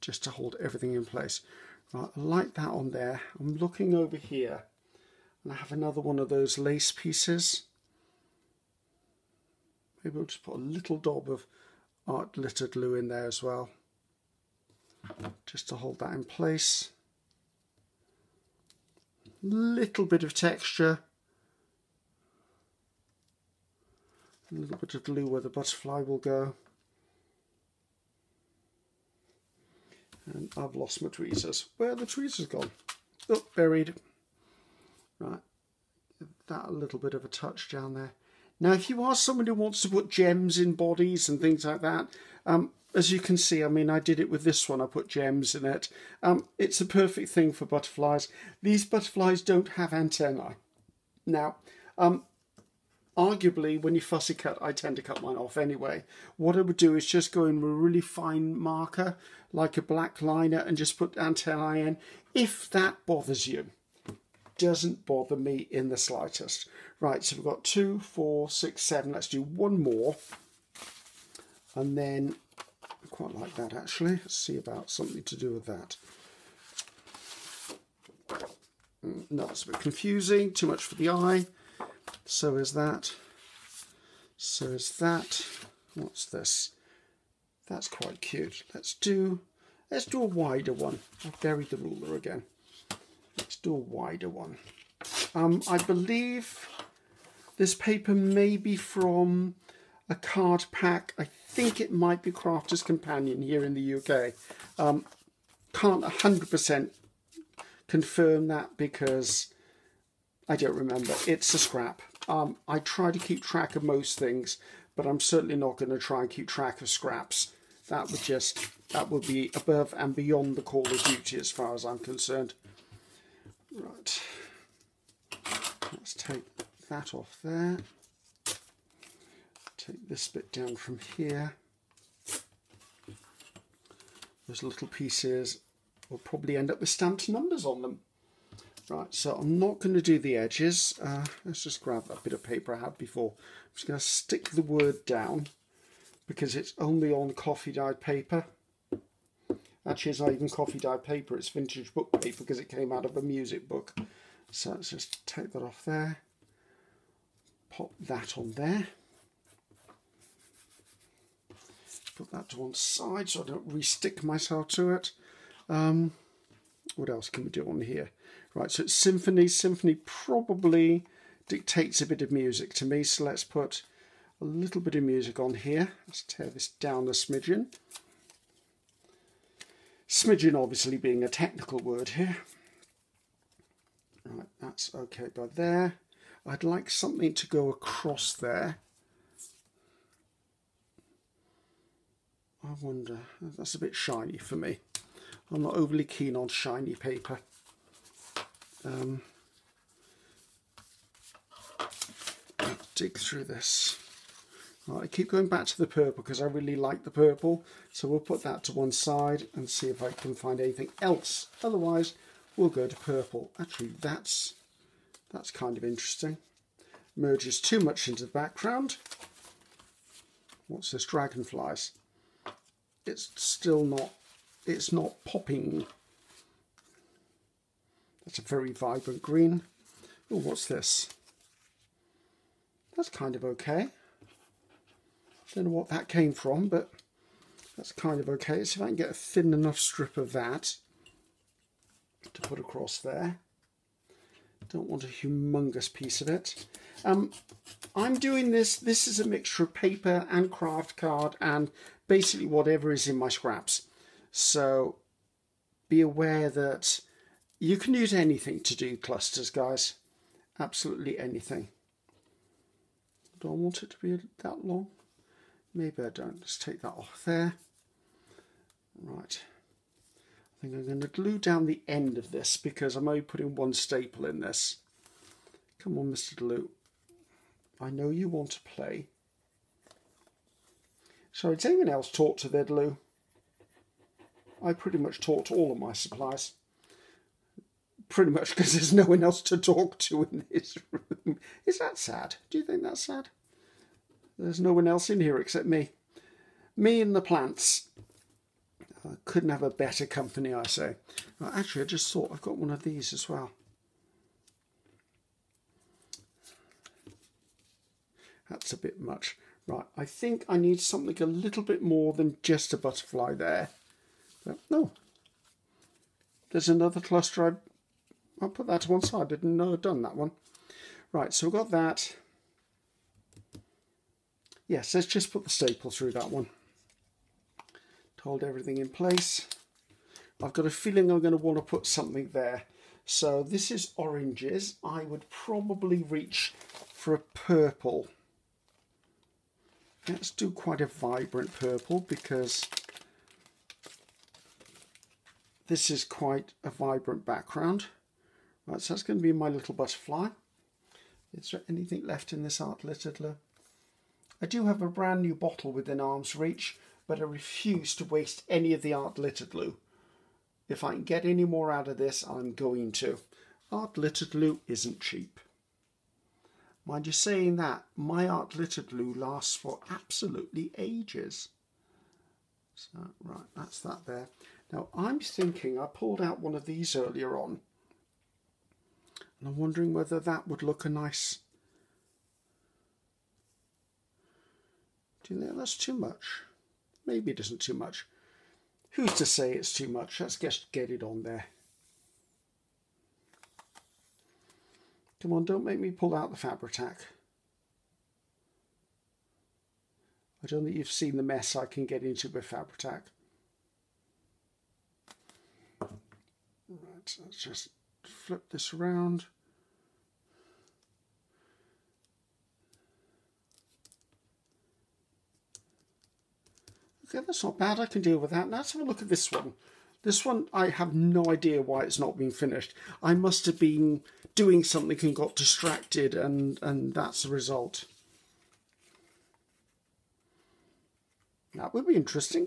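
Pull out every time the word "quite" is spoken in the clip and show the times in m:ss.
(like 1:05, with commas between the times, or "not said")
1:13, 1:27, 5:40, 5:46.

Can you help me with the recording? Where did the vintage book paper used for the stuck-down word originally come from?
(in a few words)
a music book.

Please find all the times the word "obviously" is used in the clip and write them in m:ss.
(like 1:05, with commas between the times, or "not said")
3:00.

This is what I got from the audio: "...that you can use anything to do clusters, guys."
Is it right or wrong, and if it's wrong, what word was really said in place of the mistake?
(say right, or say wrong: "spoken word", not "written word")
right.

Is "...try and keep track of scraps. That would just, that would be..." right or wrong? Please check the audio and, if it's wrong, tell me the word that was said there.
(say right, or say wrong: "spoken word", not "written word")
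right.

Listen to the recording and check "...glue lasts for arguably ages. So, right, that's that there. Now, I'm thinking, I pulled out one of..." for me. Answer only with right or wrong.
wrong.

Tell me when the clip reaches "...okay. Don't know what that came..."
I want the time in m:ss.
3:53.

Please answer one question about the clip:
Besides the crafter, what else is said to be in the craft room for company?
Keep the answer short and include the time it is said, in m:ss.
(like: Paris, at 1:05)
the plants, at 4:57.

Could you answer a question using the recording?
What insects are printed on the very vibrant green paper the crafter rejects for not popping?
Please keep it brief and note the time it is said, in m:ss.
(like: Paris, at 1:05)
Dragonflies, at 3:41.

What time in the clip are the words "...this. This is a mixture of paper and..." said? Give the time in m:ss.
4:08.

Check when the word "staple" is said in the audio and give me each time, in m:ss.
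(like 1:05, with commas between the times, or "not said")
4:33, 5:25.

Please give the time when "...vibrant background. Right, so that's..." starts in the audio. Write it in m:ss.
5:46.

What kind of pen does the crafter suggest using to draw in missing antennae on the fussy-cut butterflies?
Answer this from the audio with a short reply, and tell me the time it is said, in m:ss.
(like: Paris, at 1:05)
black liner, at 0:59.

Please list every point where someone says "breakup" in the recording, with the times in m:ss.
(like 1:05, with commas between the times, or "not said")
not said.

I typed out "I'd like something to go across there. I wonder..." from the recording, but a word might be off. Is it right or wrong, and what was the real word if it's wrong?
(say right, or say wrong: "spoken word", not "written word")
right.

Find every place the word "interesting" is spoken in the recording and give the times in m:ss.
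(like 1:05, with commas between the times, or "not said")
3:35, 7:11.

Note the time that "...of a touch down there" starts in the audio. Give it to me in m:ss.
0:37.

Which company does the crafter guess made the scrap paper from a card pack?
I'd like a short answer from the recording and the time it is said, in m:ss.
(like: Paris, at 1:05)
Crafter's Companion, at 1:42.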